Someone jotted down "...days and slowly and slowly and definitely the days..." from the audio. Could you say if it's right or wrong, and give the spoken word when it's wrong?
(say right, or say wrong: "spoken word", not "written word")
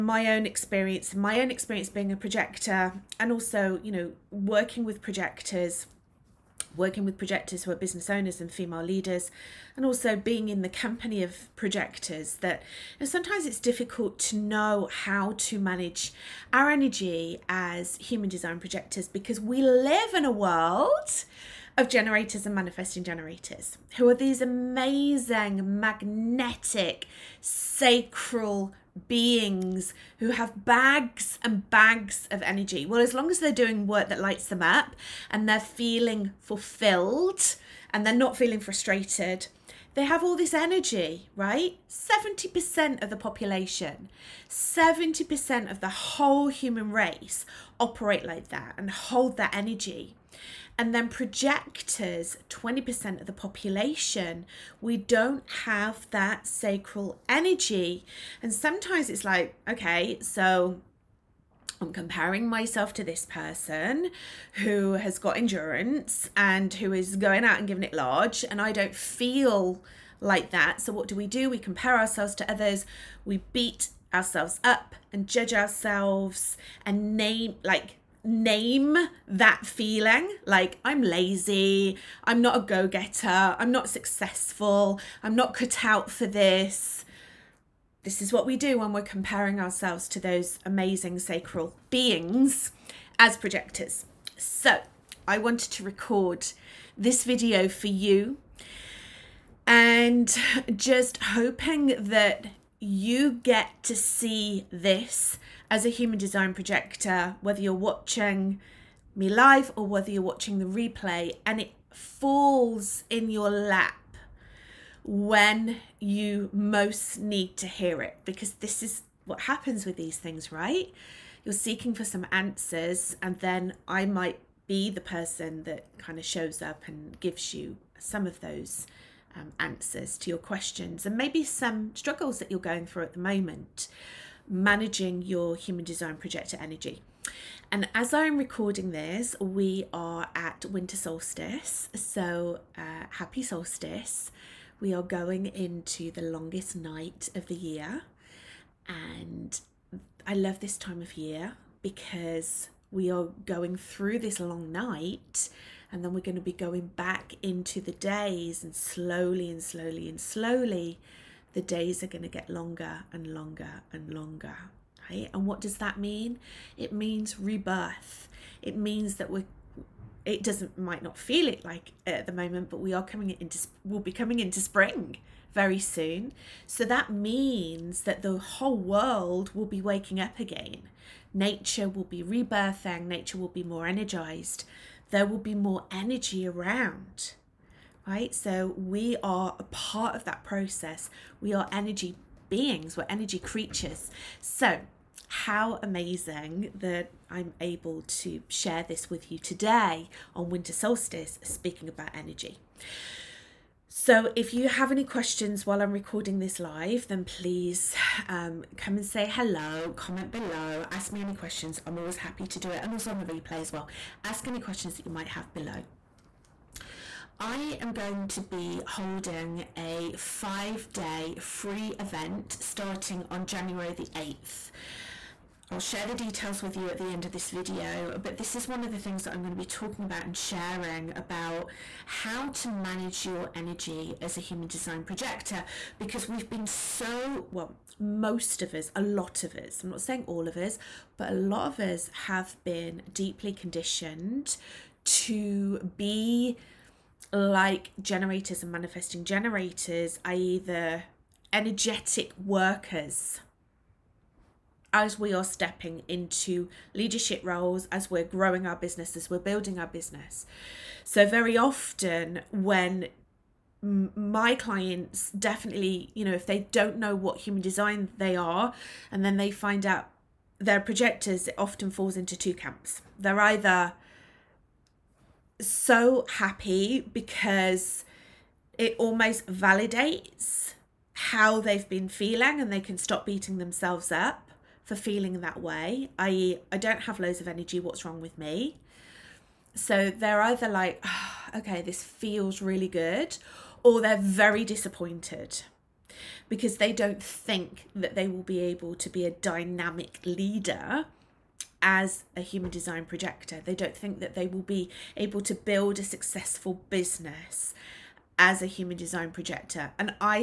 wrong: "slowly", not "definitely".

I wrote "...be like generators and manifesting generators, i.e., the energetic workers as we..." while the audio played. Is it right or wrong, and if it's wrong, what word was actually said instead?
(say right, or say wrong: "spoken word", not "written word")
right.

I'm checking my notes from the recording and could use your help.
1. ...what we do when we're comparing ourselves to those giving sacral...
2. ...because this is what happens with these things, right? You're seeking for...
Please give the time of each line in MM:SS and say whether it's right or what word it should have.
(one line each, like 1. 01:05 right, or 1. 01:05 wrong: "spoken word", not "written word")
1. 01:28 wrong: "amazing", not "giving"
2. 01:58 right.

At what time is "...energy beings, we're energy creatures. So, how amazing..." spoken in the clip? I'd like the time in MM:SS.
03:11.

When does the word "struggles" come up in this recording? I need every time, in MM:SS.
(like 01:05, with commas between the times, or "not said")
02:11.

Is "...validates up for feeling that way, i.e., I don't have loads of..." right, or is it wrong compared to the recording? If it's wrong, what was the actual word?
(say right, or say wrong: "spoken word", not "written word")
wrong: "themselves", not "validates".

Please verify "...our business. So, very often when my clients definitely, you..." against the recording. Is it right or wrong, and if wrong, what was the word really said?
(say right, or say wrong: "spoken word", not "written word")
right.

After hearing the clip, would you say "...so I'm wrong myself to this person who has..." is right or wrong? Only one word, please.
wrong.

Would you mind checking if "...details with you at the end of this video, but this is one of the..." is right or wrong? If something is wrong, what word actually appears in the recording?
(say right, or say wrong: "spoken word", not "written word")
right.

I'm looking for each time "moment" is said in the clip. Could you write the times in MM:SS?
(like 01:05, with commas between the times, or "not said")
02:13, 02:52.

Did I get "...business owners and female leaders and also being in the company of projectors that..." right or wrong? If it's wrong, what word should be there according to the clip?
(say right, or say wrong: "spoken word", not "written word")
right.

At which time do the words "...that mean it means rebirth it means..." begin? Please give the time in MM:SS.
02:45.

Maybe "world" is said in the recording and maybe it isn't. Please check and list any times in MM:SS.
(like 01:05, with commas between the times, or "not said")
00:20, 02:58.